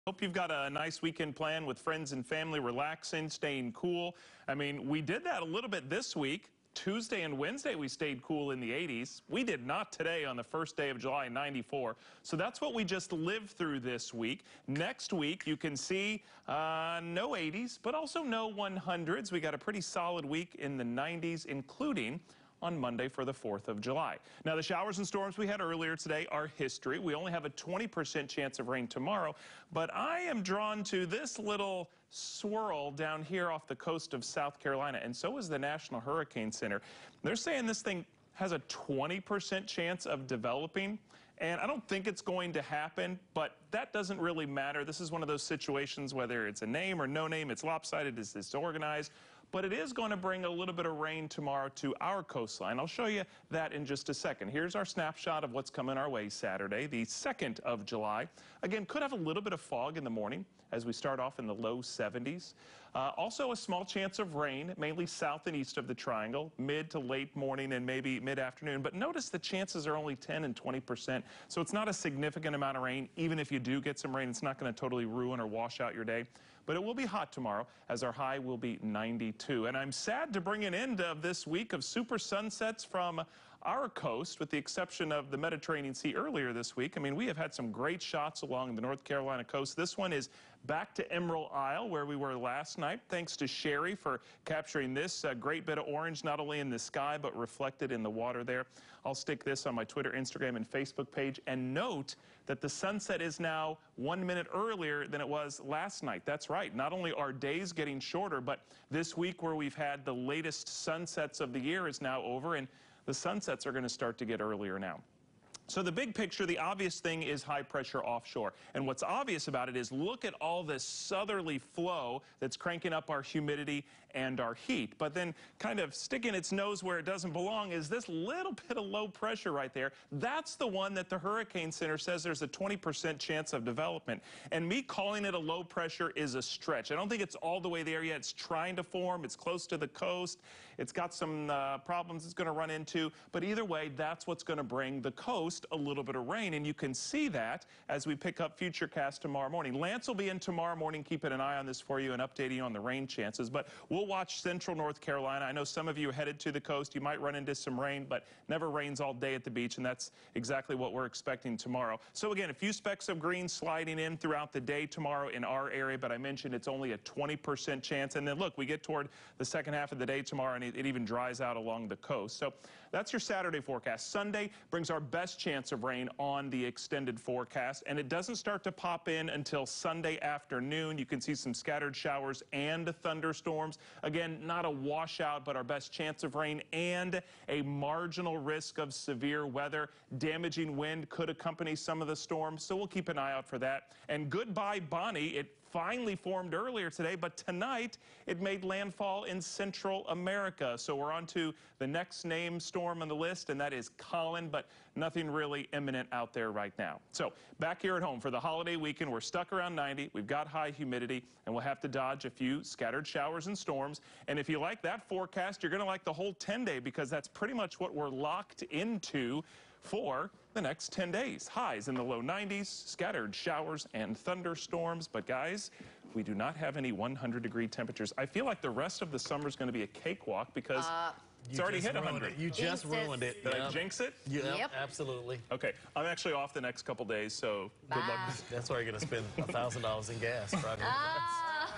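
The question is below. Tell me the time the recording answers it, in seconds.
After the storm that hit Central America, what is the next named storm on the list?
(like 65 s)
203 s.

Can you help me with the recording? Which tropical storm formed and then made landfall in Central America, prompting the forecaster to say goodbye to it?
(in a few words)
Bonnie.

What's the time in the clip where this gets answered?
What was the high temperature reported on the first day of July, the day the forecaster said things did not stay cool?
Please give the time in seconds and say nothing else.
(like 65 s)
11 s.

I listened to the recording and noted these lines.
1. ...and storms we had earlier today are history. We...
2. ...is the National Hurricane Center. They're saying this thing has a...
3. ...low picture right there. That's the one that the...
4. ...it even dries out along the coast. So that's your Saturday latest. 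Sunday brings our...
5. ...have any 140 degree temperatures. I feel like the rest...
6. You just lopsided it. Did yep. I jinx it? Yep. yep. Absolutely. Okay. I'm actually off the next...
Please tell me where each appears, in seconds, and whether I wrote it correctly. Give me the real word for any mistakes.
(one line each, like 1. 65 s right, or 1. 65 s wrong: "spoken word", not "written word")
1. 24 s right
2. 35 s right
3. 128 s wrong: "pressure", not "picture"
4. 170 s wrong: "forecast", not "latest"
5. 226 s wrong: "100", not "140"
6. 232 s wrong: "ruined", not "lopsided".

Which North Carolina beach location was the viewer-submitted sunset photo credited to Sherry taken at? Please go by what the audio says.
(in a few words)
Emerald Isle.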